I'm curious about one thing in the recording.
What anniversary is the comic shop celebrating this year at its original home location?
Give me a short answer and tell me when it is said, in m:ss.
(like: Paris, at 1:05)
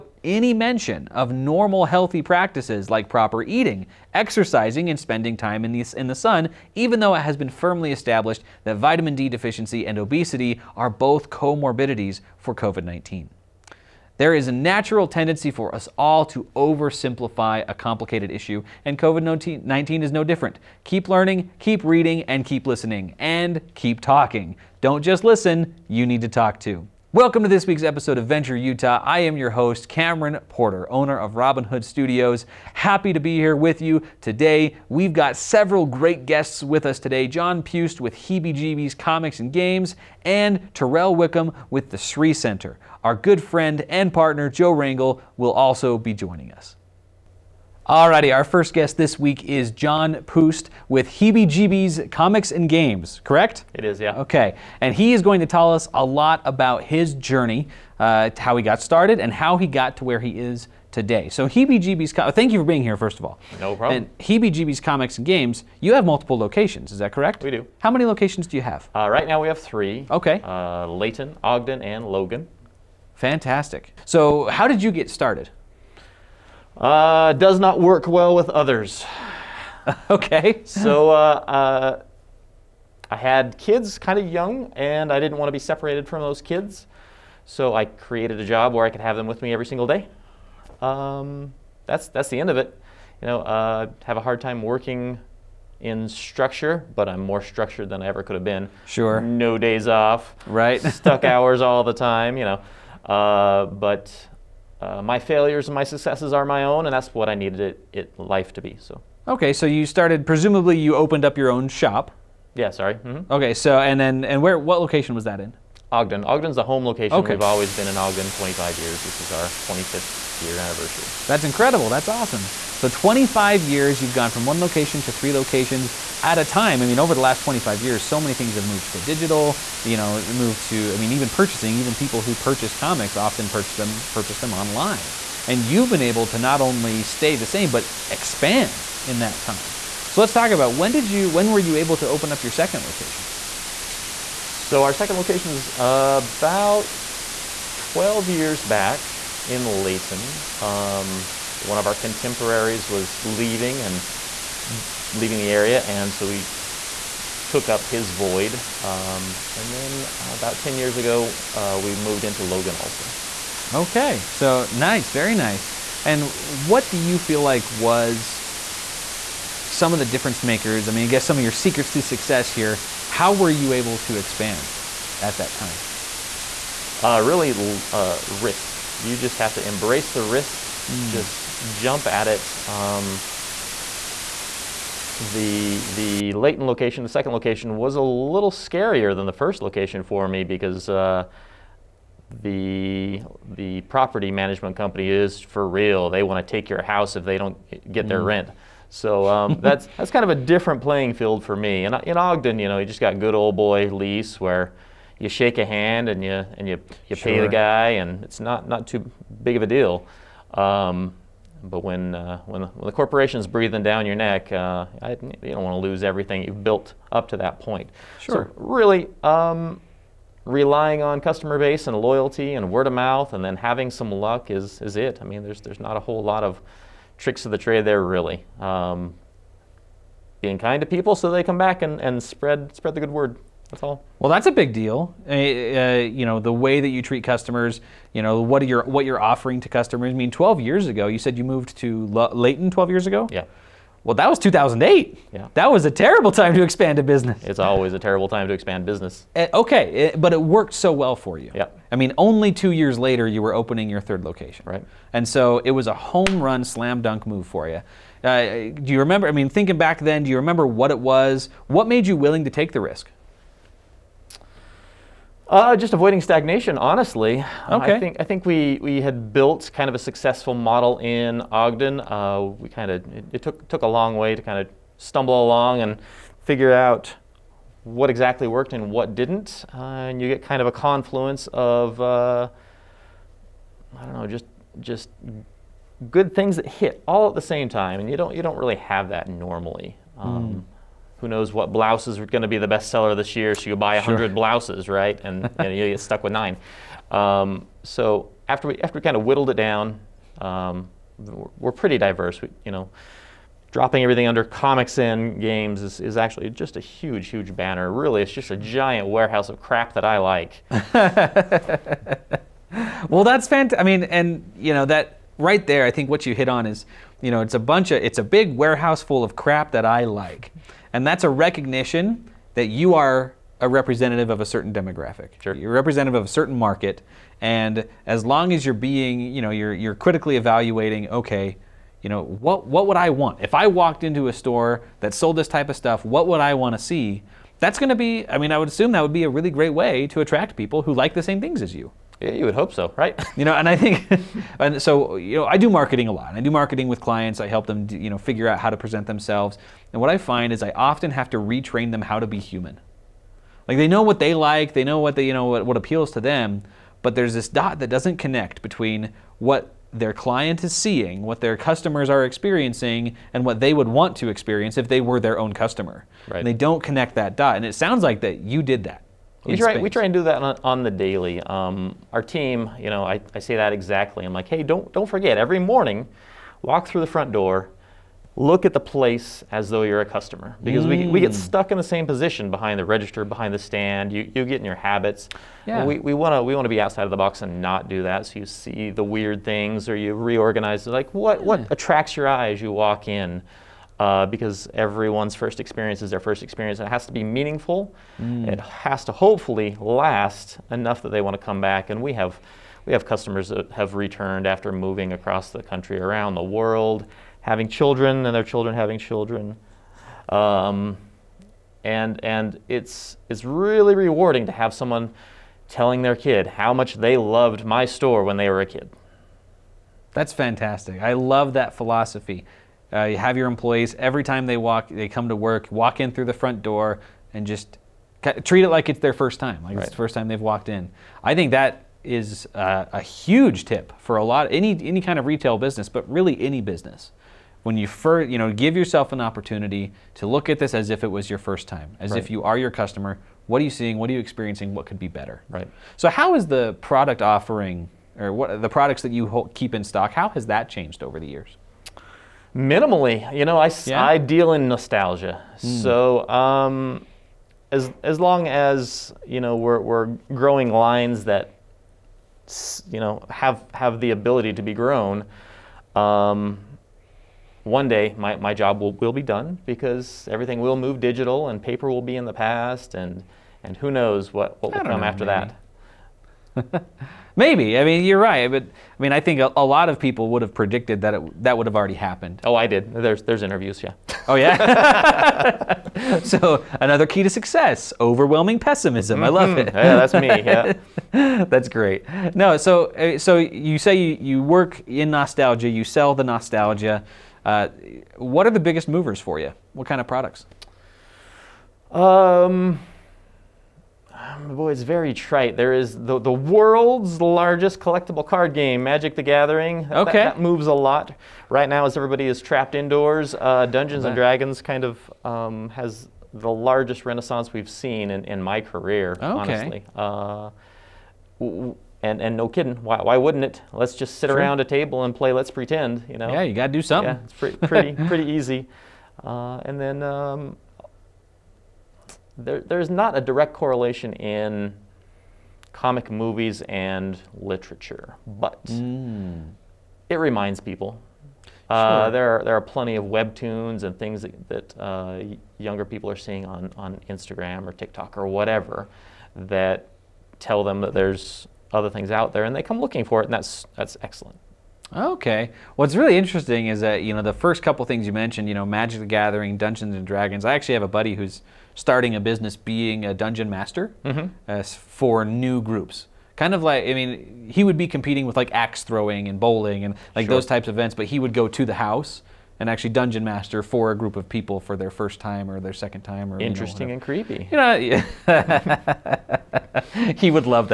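25th, at 1:59.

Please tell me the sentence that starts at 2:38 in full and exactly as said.
Um, and then about 10 years ago, uh, we moved into Logan also.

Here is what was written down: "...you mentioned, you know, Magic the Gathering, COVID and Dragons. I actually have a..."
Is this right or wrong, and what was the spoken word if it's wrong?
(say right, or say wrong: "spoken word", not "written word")
wrong: "Dungeons", not "COVID".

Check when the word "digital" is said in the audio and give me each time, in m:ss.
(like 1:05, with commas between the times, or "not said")
2:09, 7:51.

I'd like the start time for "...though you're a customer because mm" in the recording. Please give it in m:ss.
6:19.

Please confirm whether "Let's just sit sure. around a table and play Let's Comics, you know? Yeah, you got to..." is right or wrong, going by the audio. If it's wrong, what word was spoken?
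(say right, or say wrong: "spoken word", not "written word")
wrong: "Pretend", not "Comics".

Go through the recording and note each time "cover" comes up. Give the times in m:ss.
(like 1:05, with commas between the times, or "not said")
not said.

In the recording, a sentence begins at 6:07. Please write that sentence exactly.
And it sounds like that you did that.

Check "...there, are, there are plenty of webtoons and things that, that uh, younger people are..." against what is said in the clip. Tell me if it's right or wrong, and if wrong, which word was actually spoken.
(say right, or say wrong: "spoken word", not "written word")
right.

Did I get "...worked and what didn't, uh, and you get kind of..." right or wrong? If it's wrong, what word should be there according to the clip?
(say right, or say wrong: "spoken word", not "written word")
right.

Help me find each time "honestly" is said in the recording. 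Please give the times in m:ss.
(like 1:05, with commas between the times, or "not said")
4:26, 8:39.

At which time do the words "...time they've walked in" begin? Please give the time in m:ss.
7:10.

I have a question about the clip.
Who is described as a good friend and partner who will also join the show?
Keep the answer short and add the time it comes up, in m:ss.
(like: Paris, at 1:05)
Joe Rangel, at 0:44.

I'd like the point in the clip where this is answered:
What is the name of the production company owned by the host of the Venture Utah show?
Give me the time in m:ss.
0:31.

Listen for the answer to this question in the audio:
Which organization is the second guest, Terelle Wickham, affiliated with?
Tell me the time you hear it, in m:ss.
0:41.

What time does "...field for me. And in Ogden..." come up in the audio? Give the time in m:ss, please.
3:21.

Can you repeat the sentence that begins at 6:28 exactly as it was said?
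So you see the weird things or you reorganize.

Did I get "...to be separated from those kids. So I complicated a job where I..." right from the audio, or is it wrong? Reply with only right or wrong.
wrong.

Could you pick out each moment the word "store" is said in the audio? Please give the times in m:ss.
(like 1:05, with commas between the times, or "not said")
5:34, 6:57.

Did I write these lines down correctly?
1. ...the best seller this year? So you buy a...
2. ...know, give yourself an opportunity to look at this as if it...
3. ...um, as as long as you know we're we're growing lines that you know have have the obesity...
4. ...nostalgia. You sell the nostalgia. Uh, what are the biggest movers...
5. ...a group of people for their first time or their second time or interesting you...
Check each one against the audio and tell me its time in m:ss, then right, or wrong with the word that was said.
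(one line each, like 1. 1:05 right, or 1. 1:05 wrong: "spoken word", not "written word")
1. 4:52 right
2. 7:18 right
3. 7:36 wrong: "ability", not "obesity"
4. 8:15 right
5. 9:33 right.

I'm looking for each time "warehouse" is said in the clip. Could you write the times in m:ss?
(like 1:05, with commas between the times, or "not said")
5:09, 5:18.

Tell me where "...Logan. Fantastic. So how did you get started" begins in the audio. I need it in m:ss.
1:12.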